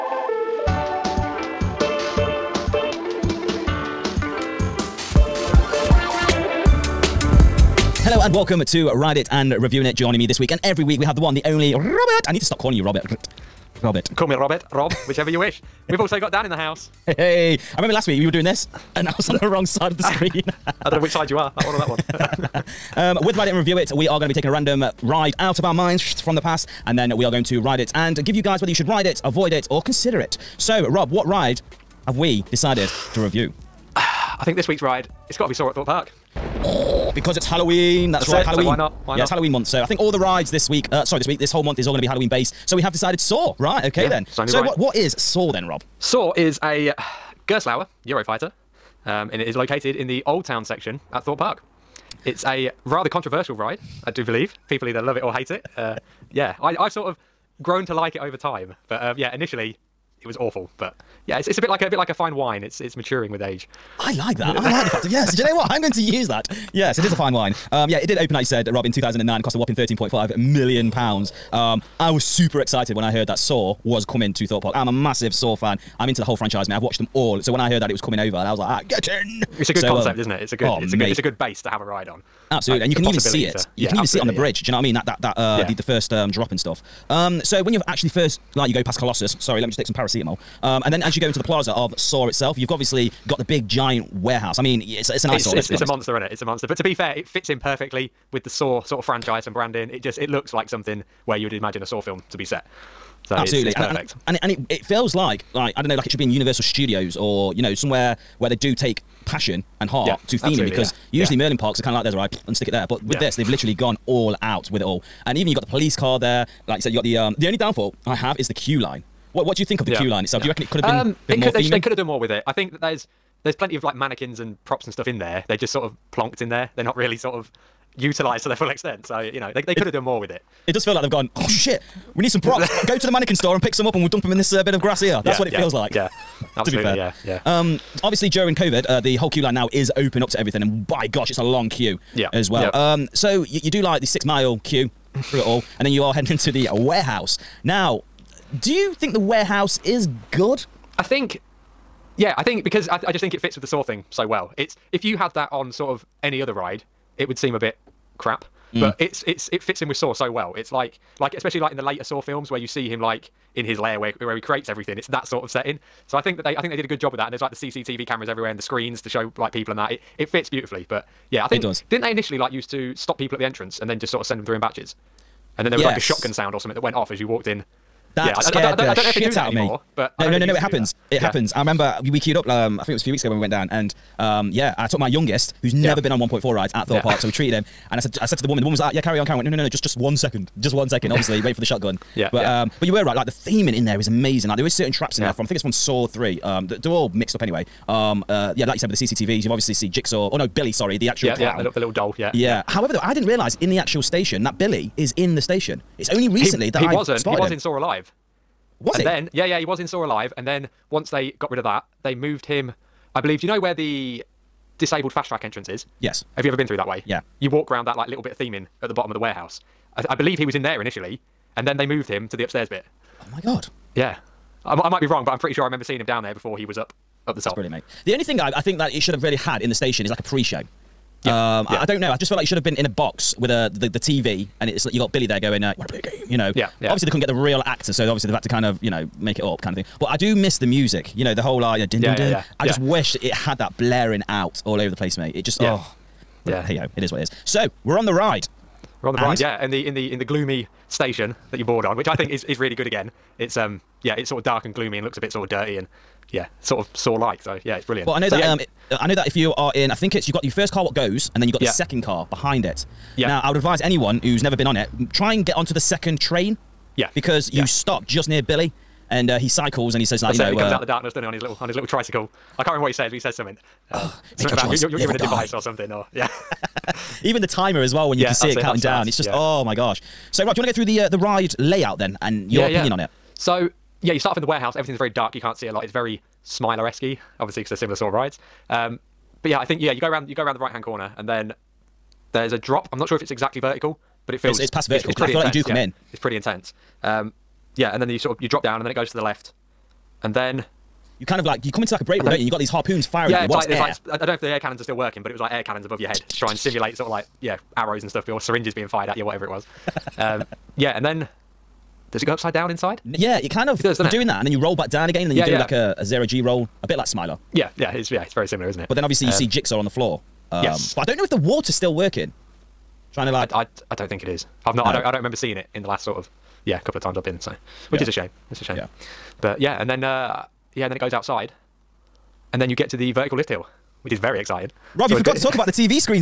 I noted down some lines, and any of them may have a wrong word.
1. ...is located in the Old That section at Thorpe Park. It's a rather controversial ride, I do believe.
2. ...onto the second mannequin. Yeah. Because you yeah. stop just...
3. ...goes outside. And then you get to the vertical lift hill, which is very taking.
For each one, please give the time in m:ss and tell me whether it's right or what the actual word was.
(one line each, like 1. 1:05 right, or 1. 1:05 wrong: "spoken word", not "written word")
1. 0:49 wrong: "Town", not "That"
2. 4:25 wrong: "train", not "mannequin"
3. 5:30 wrong: "exciting", not "taking".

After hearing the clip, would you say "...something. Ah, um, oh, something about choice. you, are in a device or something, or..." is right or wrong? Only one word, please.
right.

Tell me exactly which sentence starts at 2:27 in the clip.
Now, do you think the warehouse is Good.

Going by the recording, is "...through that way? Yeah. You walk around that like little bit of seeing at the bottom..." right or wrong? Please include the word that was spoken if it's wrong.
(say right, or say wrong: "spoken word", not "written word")
wrong: "theming", not "seeing".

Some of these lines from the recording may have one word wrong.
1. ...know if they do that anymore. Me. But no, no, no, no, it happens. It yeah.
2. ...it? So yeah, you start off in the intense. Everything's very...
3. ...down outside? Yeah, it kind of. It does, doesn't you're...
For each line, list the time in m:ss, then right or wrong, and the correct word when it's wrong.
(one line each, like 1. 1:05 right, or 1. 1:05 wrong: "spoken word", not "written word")
1. 2:59 right
2. 4:42 wrong: "warehouse", not "intense"
3. 5:12 wrong: "inside", not "outside".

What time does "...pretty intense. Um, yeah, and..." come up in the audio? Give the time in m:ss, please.
4:56.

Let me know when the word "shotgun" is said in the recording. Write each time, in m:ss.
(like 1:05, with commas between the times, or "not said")
2:55, 3:11.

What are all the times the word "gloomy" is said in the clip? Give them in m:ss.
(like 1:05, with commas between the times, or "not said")
4:10, 4:14.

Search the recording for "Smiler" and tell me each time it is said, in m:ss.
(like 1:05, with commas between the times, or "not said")
4:46, 5:17.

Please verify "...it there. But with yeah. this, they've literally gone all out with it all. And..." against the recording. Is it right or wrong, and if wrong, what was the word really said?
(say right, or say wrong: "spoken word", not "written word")
right.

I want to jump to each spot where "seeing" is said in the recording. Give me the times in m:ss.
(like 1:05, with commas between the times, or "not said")
3:45, 5:25.